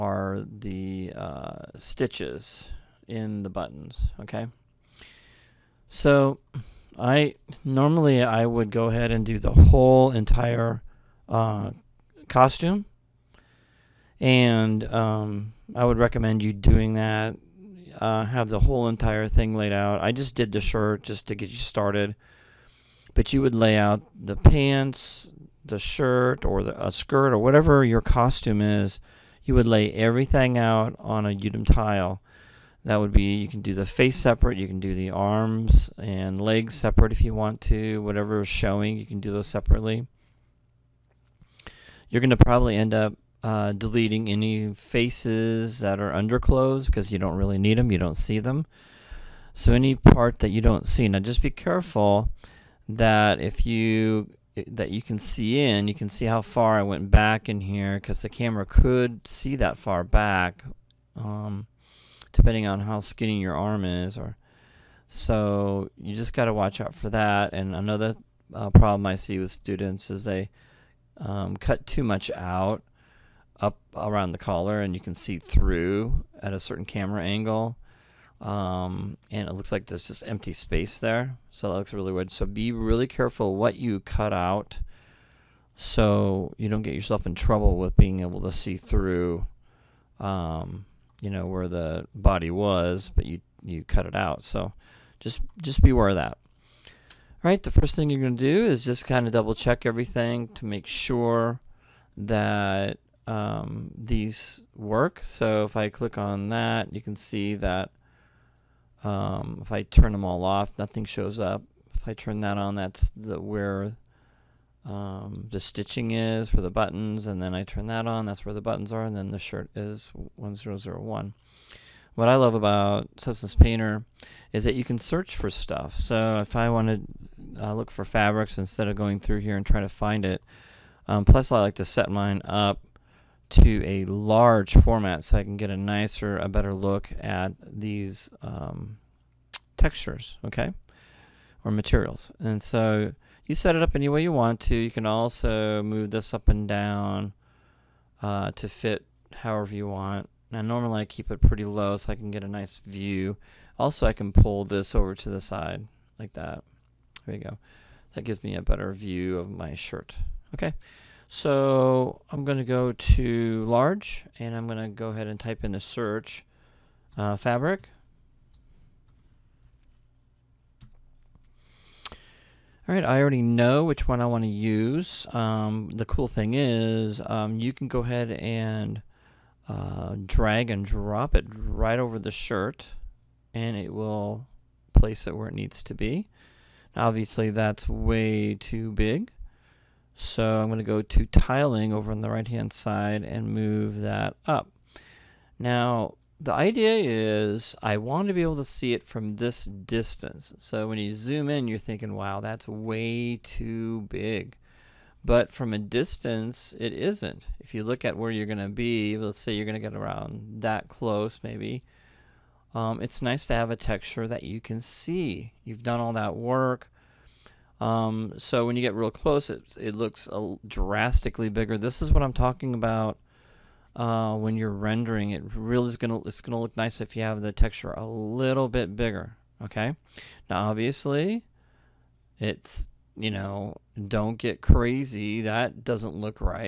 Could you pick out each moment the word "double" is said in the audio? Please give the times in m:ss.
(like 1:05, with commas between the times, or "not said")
1:39.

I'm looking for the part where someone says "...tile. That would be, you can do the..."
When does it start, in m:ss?
0:31.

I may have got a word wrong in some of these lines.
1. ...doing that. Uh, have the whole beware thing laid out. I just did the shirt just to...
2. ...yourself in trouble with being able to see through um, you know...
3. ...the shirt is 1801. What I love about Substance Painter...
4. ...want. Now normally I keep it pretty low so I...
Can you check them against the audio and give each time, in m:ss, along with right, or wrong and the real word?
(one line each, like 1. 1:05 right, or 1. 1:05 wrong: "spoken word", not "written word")
1. 0:16 wrong: "entire", not "beware"
2. 1:26 right
3. 1:59 wrong: "1001", not "1801"
4. 2:29 right.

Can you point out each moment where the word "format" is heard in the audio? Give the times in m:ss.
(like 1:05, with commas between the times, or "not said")
2:14.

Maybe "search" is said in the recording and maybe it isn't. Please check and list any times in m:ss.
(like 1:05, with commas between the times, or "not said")
2:04, 2:45.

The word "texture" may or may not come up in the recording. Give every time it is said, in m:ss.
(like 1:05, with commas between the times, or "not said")
2:19, 3:33, 3:47.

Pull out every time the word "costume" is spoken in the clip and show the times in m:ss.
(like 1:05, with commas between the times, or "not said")
0:12, 0:28.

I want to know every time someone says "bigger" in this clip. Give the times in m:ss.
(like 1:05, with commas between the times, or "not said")
3:41, 3:48.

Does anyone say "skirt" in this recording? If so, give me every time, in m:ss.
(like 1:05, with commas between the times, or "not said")
0:26.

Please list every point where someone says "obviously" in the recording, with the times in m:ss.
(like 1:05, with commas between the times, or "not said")
3:06, 3:50.